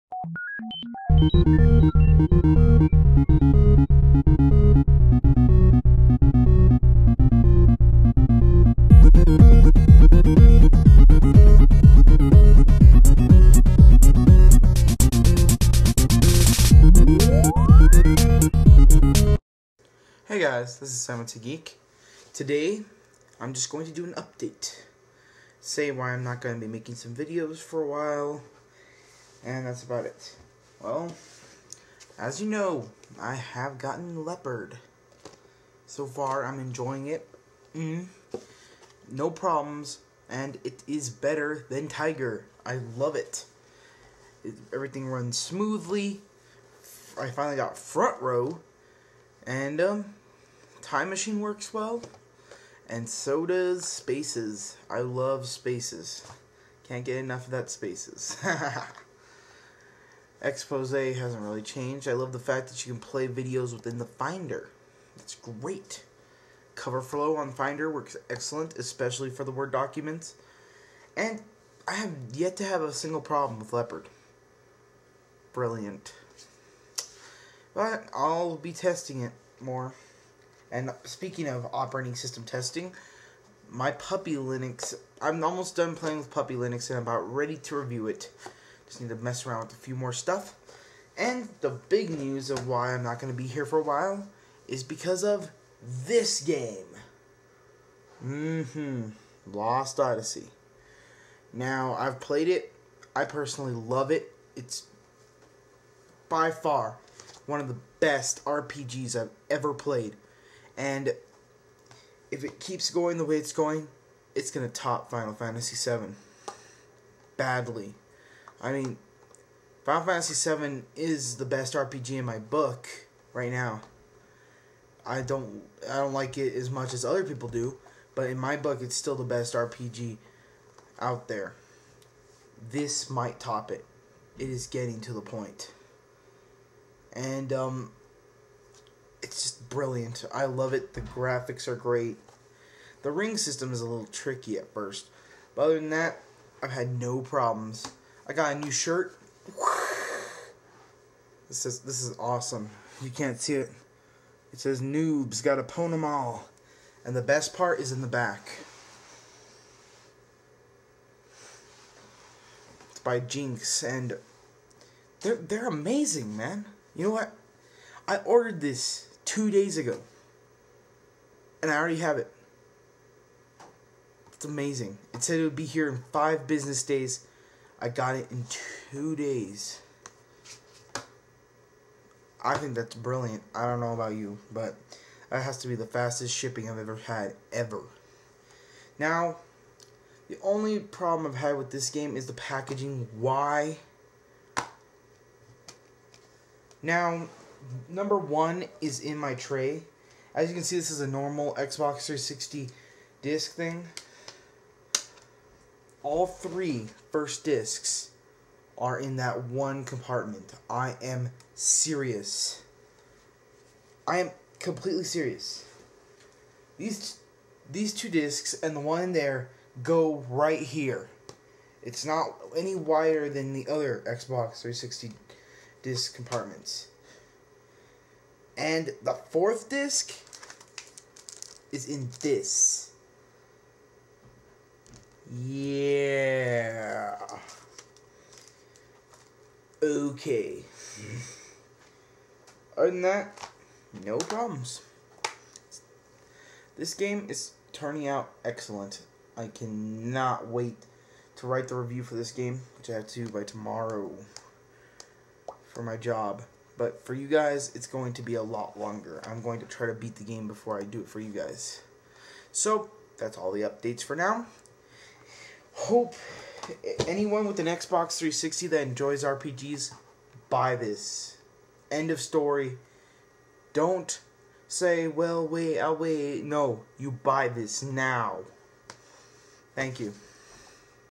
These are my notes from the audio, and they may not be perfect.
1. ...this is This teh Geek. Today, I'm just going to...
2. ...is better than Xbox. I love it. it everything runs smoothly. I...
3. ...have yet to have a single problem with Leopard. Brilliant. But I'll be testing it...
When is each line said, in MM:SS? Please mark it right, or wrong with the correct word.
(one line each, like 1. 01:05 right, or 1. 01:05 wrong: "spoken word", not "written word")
1. 00:20 wrong: "Samuel", not "This"
2. 00:40 wrong: "Tiger", not "Xbox"
3. 01:11 right.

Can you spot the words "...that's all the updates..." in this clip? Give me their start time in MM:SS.
04:23.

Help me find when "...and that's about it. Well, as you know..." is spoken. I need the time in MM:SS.
00:29.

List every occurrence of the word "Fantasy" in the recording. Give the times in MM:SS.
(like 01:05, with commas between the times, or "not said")
01:55, 02:00.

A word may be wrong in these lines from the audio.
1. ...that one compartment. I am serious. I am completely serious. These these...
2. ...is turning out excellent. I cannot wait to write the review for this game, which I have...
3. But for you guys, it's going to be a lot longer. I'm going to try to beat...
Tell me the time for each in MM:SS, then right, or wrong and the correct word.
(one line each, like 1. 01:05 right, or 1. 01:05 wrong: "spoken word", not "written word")
1. 03:29 right
2. 04:07 right
3. 04:16 right.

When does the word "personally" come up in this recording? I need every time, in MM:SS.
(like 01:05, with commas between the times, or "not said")
01:43.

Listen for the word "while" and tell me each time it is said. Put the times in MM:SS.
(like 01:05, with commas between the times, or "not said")
00:27, 01:33.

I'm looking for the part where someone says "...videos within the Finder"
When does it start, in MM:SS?
01:03.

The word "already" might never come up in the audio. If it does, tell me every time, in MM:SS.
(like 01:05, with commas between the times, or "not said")
02:51.